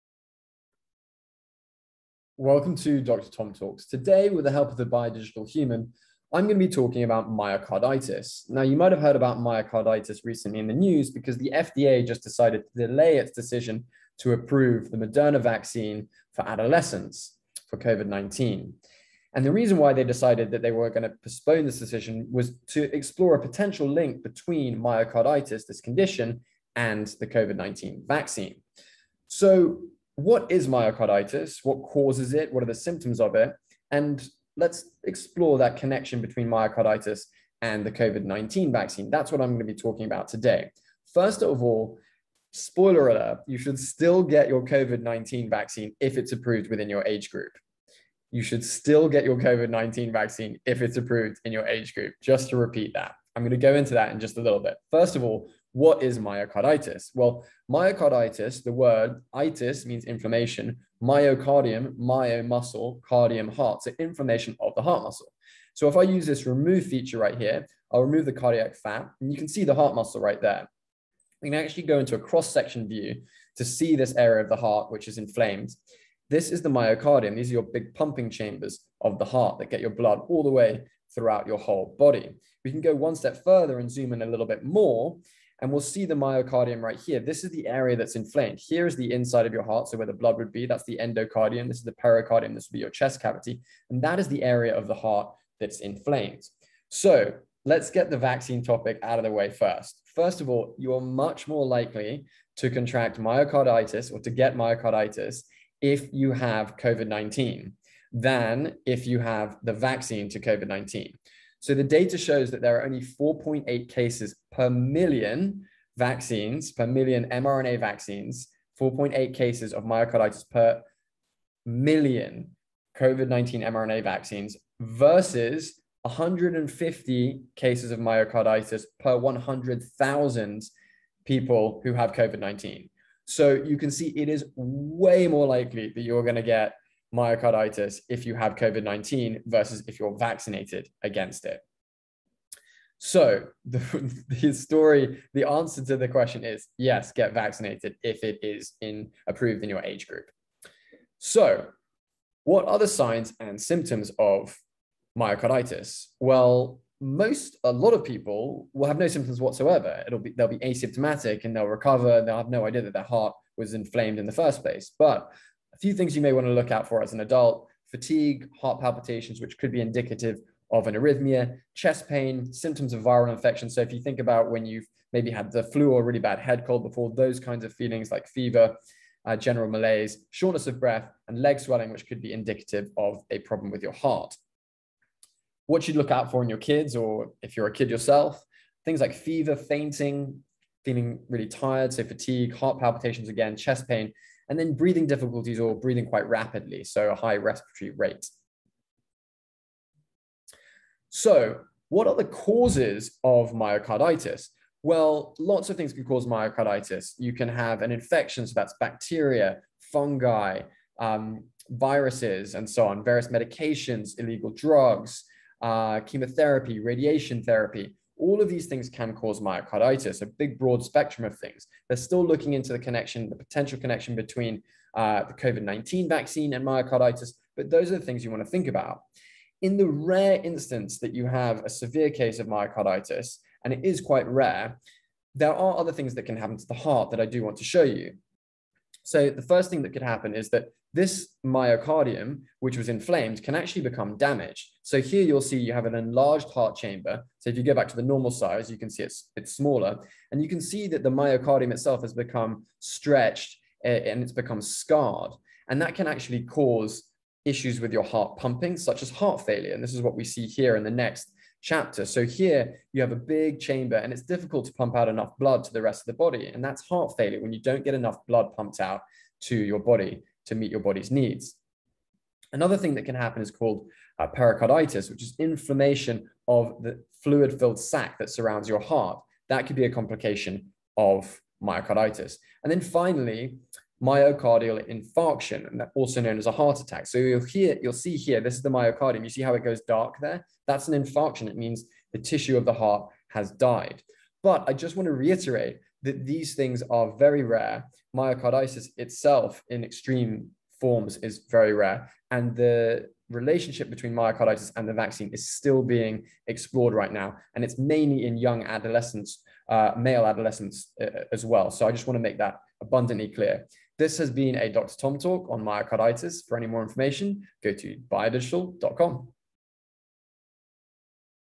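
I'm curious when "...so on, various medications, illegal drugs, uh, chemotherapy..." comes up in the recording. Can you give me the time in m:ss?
3:32.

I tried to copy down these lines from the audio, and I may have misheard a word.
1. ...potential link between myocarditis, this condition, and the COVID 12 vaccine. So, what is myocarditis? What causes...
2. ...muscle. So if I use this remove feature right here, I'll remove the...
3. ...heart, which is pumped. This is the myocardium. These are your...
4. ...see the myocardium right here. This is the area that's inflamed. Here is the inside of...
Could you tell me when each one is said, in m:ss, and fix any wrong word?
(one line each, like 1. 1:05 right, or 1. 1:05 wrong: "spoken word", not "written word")
1. 0:23 wrong: "19", not "12"
2. 1:05 right
3. 1:14 wrong: "inflamed", not "pumped"
4. 1:25 right.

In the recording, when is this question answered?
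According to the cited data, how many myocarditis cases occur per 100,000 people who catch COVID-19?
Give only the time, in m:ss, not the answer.
2:06.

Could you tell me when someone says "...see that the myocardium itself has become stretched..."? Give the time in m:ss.
4:10.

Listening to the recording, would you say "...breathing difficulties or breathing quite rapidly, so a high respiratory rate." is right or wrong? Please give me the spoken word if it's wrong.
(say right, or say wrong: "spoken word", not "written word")
right.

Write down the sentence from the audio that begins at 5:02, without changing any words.
And the relationship between myocarditis and the vaccine is still being explored right now.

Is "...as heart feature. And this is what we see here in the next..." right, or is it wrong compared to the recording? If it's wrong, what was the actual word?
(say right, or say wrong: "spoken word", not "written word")
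wrong: "failure", not "feature".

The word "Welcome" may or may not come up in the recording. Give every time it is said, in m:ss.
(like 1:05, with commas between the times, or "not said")
0:02.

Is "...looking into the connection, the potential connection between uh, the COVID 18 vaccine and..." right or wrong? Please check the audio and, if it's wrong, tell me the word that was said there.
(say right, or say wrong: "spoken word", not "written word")
wrong: "19", not "18".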